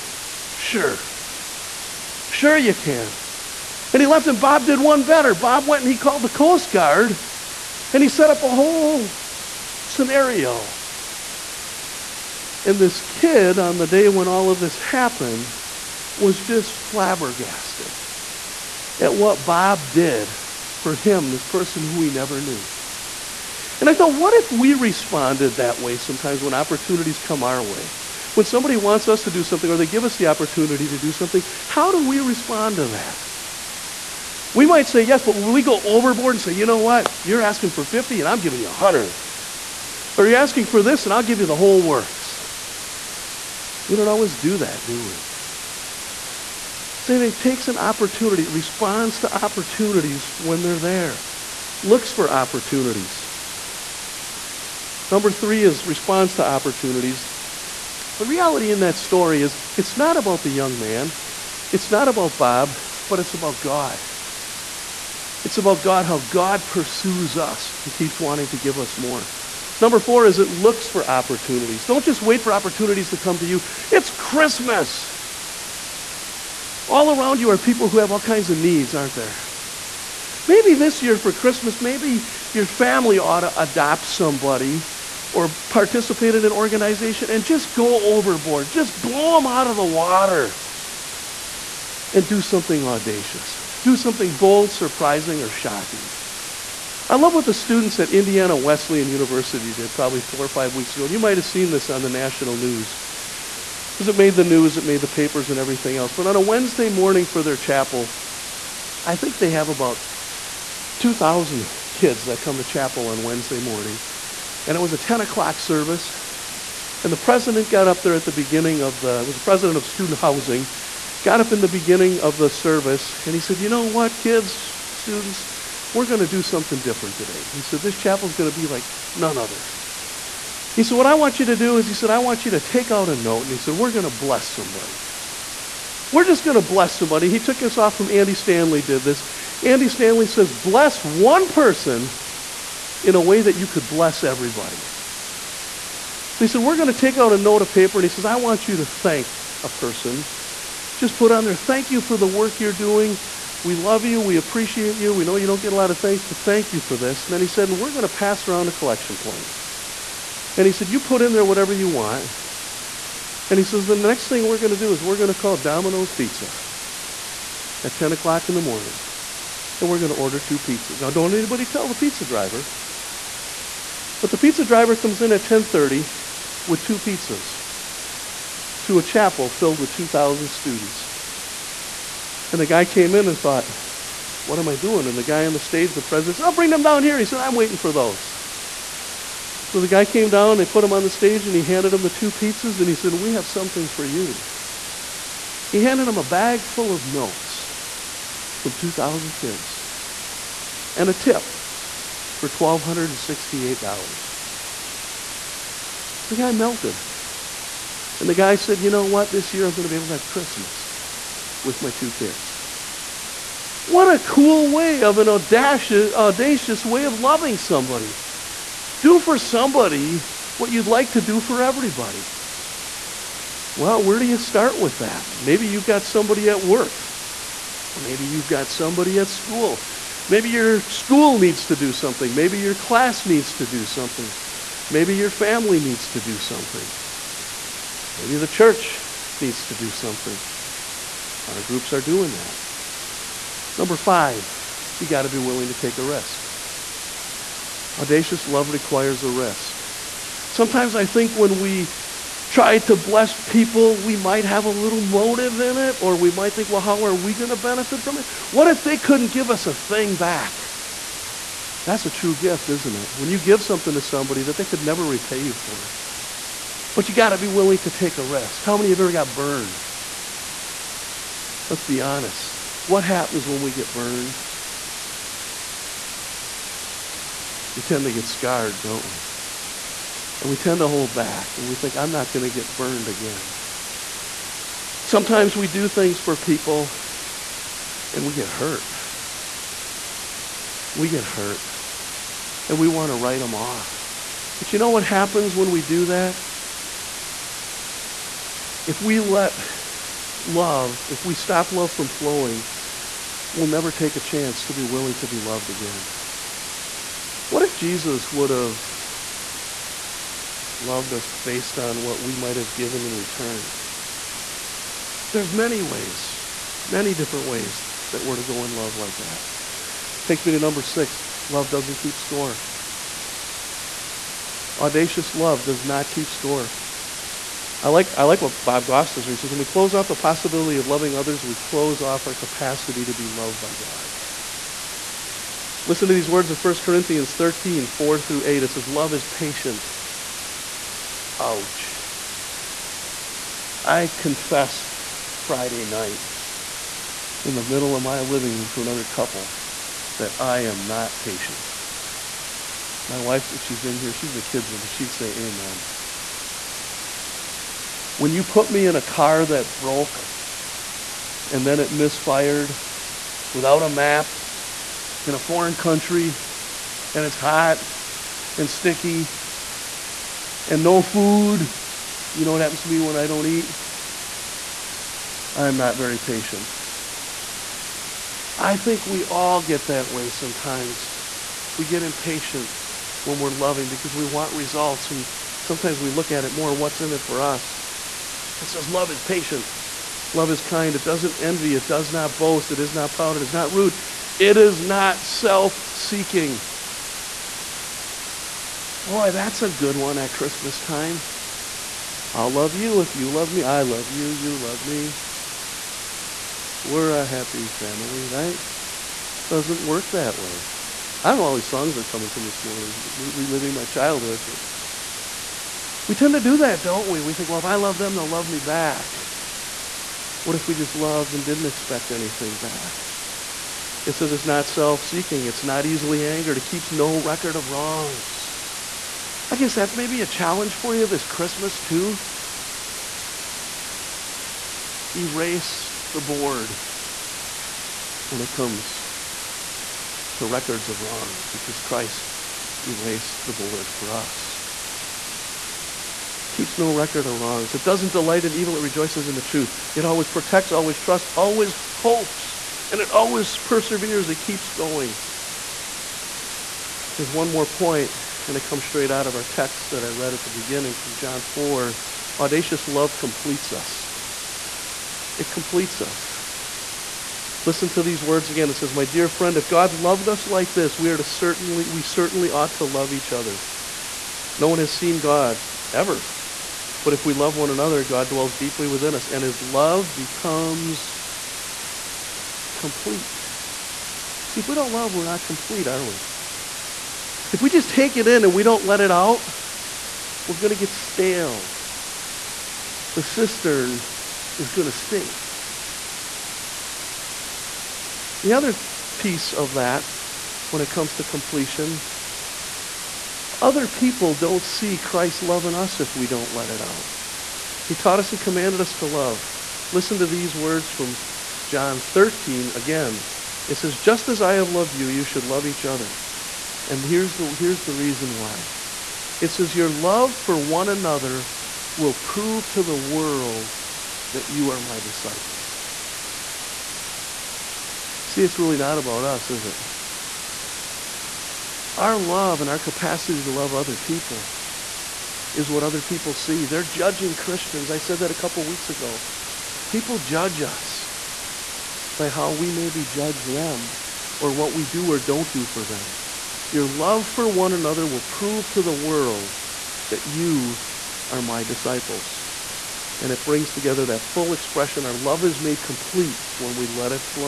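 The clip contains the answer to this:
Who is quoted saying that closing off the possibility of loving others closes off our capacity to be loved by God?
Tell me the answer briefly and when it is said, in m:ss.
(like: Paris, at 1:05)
Bob Goff, at 5:28.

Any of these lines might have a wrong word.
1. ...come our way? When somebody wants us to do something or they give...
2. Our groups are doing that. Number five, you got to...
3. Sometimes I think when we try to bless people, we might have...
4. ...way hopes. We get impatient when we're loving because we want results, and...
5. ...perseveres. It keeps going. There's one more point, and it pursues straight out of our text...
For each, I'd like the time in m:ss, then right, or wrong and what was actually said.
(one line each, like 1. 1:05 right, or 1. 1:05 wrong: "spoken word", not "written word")
1. 0:27 right
2. 4:01 right
3. 4:10 right
4. 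6:20 wrong: "sometimes", not "hopes"
5. 7:33 wrong: "comes", not "pursues".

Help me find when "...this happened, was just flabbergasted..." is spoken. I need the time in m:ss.
0:14.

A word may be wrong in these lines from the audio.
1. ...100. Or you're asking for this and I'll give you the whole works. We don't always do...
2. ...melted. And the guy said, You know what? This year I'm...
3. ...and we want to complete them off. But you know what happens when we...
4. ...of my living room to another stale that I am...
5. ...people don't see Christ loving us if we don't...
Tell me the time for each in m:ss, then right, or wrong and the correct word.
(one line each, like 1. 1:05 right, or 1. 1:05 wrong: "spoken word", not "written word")
1. 0:38 right
2. 3:26 right
3. 4:52 wrong: "write", not "complete"
4. 5:47 wrong: "couple", not "stale"
5. 8:23 right.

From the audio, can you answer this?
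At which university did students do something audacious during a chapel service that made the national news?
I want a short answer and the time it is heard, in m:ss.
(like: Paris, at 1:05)
Indiana Wesleyan University, at 1:38.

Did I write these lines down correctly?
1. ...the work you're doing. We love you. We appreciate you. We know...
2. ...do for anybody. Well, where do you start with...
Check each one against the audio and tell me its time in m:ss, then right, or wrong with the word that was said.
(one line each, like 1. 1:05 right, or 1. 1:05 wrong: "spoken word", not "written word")
1. 2:32 right
2. 3:41 wrong: "everybody", not "anybody".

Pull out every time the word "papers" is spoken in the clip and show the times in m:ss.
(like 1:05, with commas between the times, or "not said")
1:45, 2:27.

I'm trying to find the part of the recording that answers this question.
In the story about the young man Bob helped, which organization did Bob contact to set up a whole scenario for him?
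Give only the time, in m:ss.
0:06.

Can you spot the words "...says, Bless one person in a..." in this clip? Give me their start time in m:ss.
2:20.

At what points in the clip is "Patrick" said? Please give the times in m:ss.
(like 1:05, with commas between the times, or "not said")
not said.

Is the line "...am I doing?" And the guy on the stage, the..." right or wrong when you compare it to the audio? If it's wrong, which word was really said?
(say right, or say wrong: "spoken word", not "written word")
right.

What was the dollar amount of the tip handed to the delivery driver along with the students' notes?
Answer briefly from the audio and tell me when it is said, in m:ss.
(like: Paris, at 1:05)
$1,268, at 3:22.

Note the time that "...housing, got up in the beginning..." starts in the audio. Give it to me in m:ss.
2:00.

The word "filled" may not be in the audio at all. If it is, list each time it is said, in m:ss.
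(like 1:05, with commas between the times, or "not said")
2:59.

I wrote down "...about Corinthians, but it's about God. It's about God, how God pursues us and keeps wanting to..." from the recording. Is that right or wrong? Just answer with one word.
wrong.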